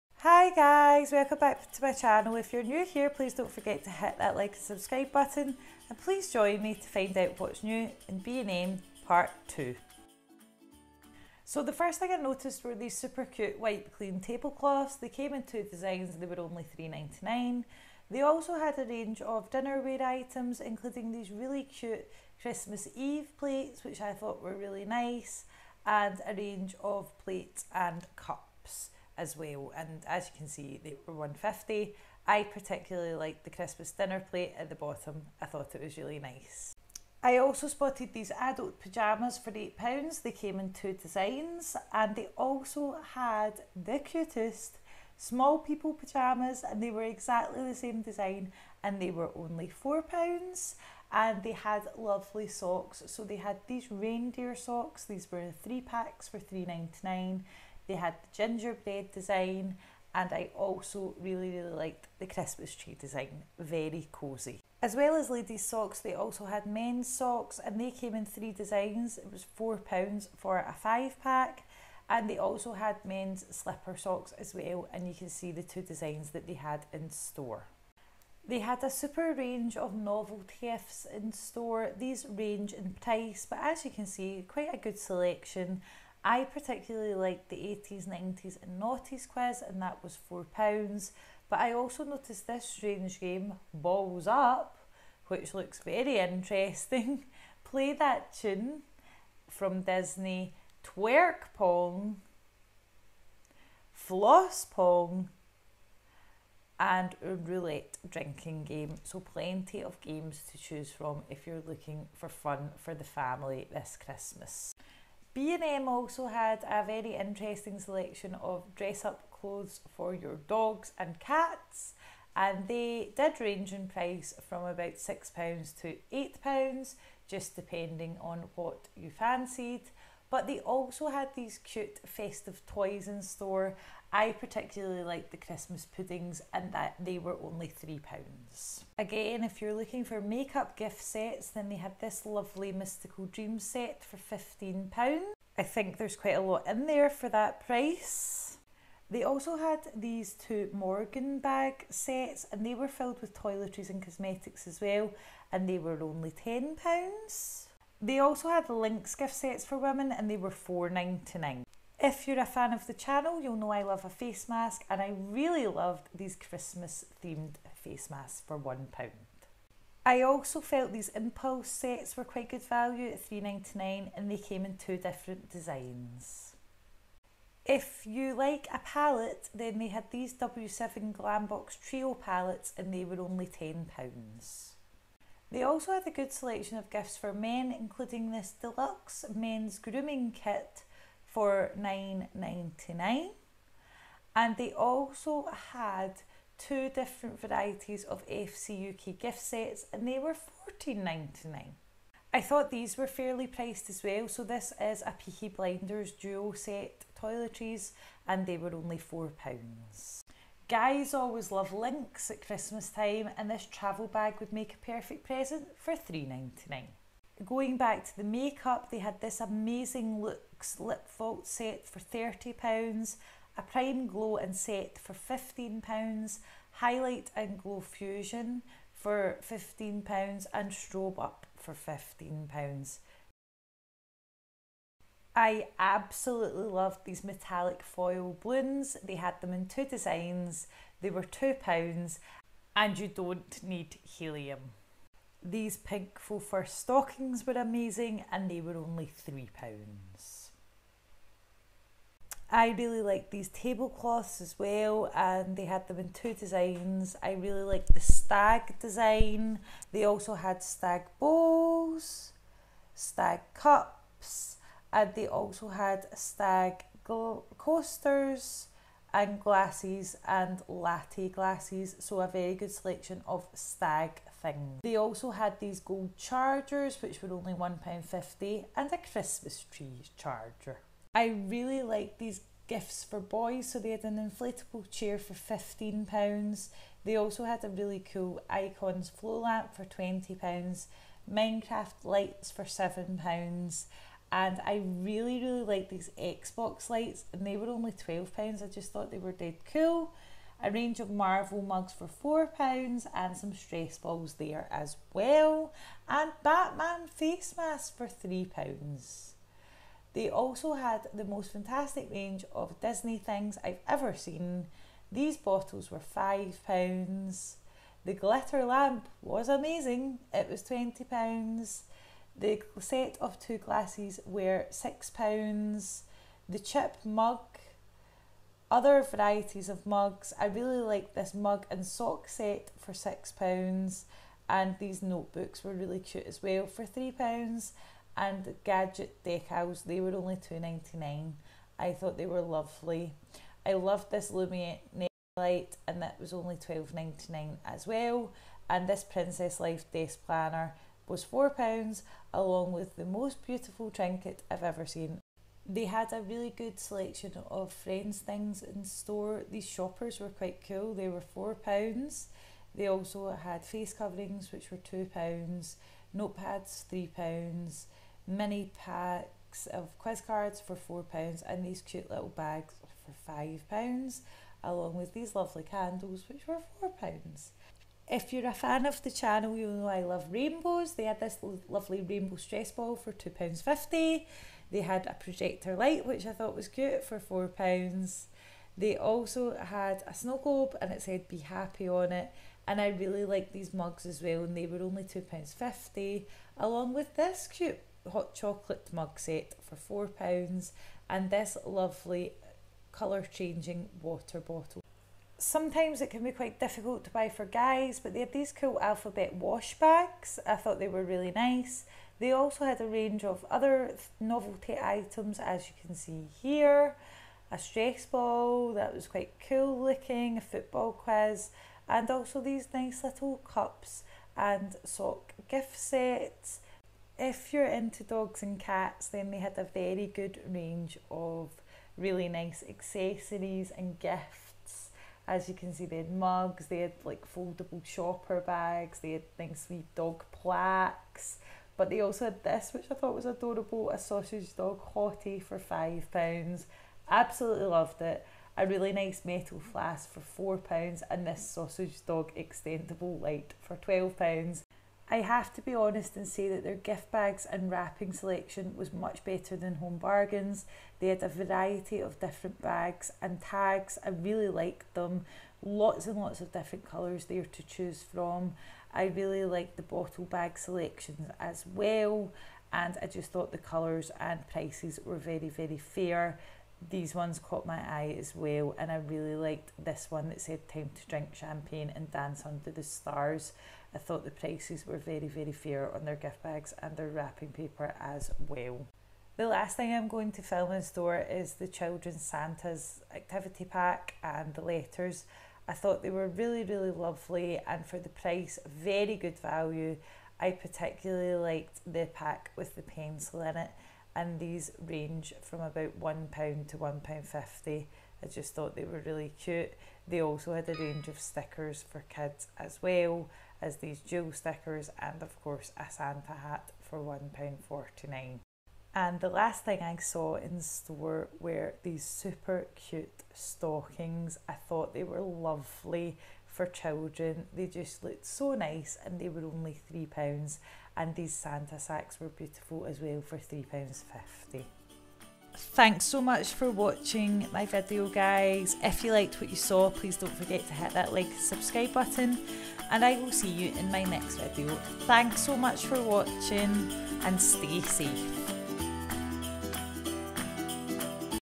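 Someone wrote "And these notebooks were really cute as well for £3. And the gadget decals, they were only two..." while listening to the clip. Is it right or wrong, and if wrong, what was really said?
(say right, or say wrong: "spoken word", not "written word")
right.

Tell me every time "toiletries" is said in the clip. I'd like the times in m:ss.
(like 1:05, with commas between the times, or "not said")
2:33, 3:27.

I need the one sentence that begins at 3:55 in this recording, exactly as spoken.
I absolutely loved these metallic foil balloons.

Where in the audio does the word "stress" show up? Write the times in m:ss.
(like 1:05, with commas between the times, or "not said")
5:03, 6:22, 6:57.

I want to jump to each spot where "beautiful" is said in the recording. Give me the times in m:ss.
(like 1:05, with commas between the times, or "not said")
5:53, 8:52.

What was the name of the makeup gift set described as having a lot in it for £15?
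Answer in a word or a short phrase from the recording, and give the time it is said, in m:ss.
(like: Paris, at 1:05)
Mystical Dream, at 2:22.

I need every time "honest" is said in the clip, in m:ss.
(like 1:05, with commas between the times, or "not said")
7:35.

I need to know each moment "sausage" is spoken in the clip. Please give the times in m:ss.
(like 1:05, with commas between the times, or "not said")
7:23, 7:31.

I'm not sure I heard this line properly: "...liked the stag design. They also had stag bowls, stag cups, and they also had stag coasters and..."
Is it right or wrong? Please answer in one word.
right.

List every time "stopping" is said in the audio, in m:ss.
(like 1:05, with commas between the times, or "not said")
not said.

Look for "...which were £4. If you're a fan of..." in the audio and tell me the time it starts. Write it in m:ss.
6:16.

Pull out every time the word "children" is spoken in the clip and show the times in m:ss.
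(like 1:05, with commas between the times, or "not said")
8:11, 8:46.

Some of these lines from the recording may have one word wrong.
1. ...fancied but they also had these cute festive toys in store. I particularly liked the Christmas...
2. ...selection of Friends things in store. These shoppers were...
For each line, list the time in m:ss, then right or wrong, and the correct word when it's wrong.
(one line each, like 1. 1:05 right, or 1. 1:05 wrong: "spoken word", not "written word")
1. 2:09 right
2. 5:56 right.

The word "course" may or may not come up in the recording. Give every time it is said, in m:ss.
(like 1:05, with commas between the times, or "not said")
8:35.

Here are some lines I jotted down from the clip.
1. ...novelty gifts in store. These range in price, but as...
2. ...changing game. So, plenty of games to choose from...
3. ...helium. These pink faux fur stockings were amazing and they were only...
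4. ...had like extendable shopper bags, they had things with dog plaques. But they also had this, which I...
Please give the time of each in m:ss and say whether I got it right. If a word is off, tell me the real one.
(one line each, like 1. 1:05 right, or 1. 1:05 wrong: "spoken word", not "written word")
1. 1:19 right
2. 1:48 wrong: "drinking", not "changing"
3. 4:04 right
4. 7:16 wrong: "foldable", not "extendable".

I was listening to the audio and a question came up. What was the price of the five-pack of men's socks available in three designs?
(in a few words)
£4.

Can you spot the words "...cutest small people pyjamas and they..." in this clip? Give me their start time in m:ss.
0:43.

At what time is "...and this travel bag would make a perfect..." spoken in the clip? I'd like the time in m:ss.
3:33.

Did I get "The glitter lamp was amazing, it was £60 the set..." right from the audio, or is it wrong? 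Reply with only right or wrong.
wrong.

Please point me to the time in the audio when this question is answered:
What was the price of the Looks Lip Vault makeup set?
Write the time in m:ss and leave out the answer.
3:41.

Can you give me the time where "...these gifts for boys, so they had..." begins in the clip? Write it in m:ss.
4:42.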